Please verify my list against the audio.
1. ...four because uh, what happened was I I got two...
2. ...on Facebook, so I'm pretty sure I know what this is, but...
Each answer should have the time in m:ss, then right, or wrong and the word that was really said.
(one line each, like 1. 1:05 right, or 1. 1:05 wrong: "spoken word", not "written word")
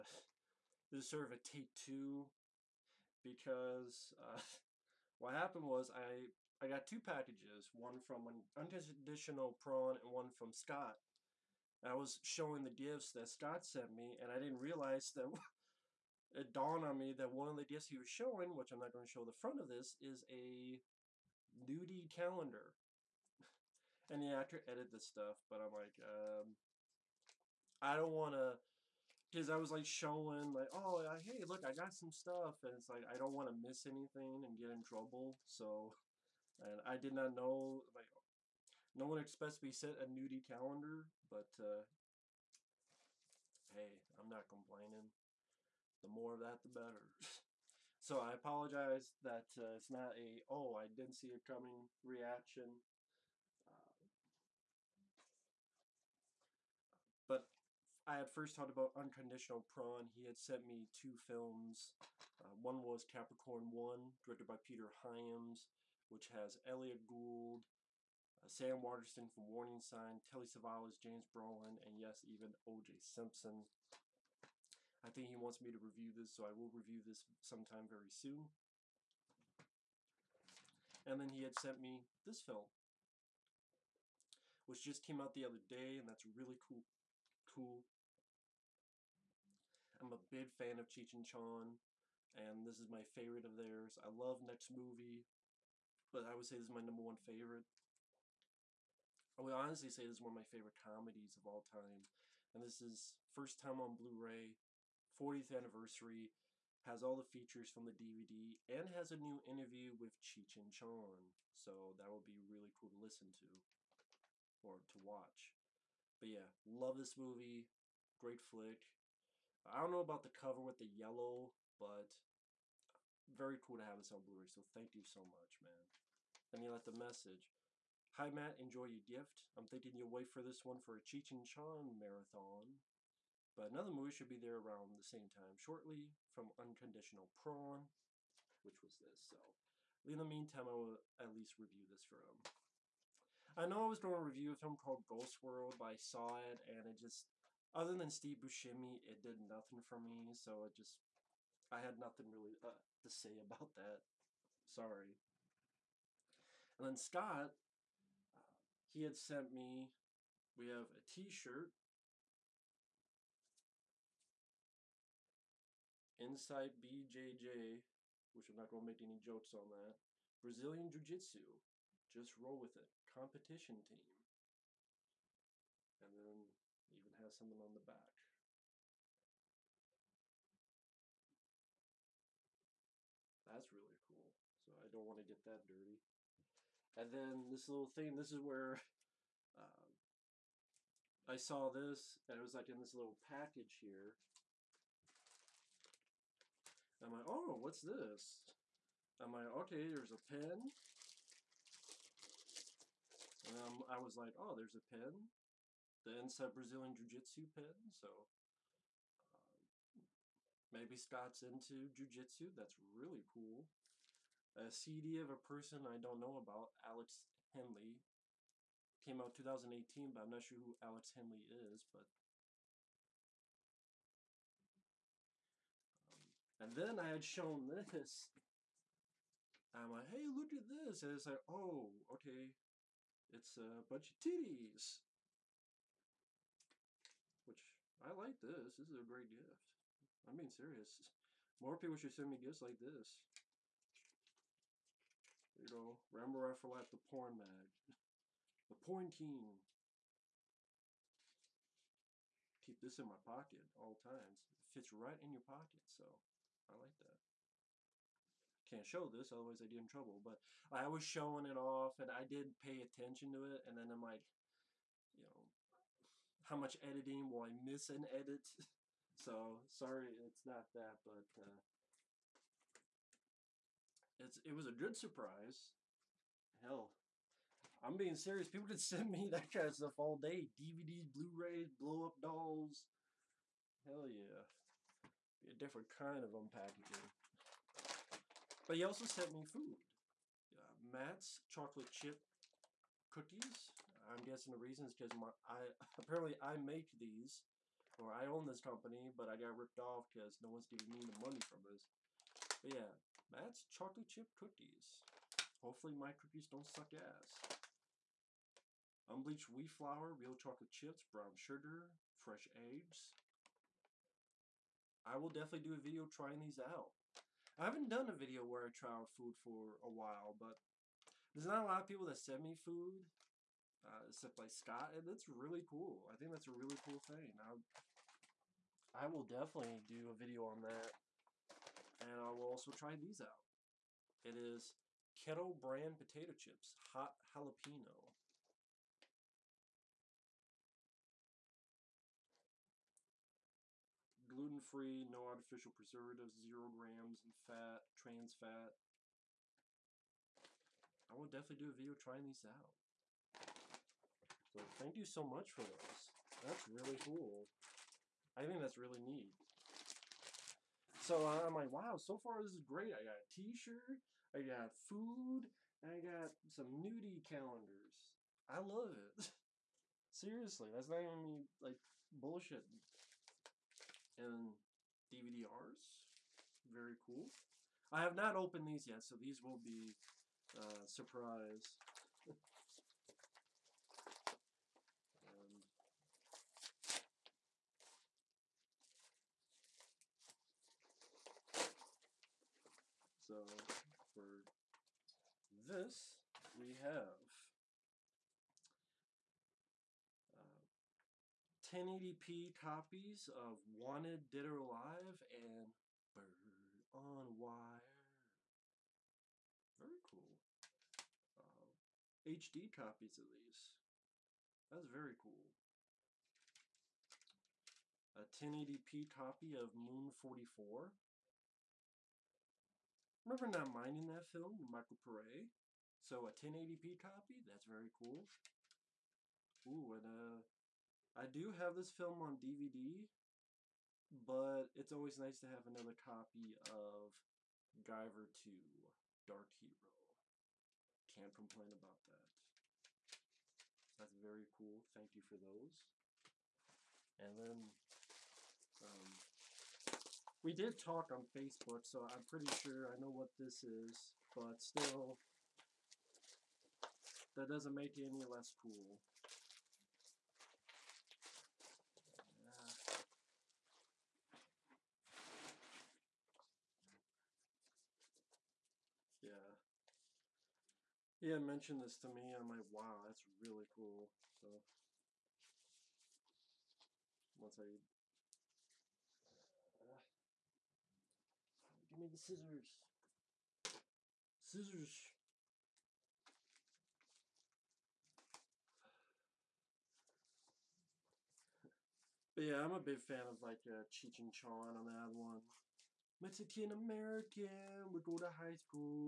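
1. 0:01 wrong: "two", not "four"
2. 7:31 right.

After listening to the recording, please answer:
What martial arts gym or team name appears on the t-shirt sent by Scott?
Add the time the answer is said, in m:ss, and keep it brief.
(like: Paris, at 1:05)
Insight BJJ, at 2:46.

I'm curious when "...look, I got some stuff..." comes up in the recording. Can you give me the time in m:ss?
0:31.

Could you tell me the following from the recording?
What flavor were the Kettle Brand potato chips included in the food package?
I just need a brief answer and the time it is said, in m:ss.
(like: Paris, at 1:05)
Hot Jalapeno, at 5:36.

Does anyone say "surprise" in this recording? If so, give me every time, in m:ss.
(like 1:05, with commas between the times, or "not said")
4:34, 6:20.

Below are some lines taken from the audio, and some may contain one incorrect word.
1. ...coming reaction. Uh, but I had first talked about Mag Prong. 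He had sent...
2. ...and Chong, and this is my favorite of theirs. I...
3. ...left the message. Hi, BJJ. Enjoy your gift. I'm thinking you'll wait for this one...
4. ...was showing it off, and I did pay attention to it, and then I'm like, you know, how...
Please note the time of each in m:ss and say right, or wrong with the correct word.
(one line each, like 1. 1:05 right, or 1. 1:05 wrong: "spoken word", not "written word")
1. 0:51 wrong: "Unconditional", not "Mag"
2. 1:31 right
3. 2:06 wrong: "Matt", not "BJJ"
4. 4:20 right.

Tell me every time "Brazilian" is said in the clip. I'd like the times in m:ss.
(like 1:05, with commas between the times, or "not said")
2:50, 3:26.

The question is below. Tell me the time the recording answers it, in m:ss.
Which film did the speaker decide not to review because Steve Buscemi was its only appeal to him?
2:25.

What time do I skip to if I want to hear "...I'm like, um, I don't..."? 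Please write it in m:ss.
0:25.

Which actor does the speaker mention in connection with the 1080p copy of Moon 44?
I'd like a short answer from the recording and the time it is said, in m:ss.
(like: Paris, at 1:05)
Michael Pare, at 7:04.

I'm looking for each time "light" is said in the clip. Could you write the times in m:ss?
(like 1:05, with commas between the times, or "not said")
not said.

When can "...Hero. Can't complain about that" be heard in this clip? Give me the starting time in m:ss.
7:19.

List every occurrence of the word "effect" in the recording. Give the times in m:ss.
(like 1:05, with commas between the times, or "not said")
not said.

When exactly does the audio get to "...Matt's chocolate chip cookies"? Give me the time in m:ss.
4:50.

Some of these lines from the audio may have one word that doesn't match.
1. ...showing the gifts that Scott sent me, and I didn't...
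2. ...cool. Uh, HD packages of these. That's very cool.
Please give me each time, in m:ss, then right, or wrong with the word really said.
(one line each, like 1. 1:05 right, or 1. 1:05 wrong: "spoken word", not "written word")
1. 0:12 right
2. 6:50 wrong: "copies", not "packages".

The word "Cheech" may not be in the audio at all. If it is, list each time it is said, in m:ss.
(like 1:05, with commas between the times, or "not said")
1:30, 1:50, 2:11, 8:13.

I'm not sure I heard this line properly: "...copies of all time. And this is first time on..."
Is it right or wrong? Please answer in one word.
wrong.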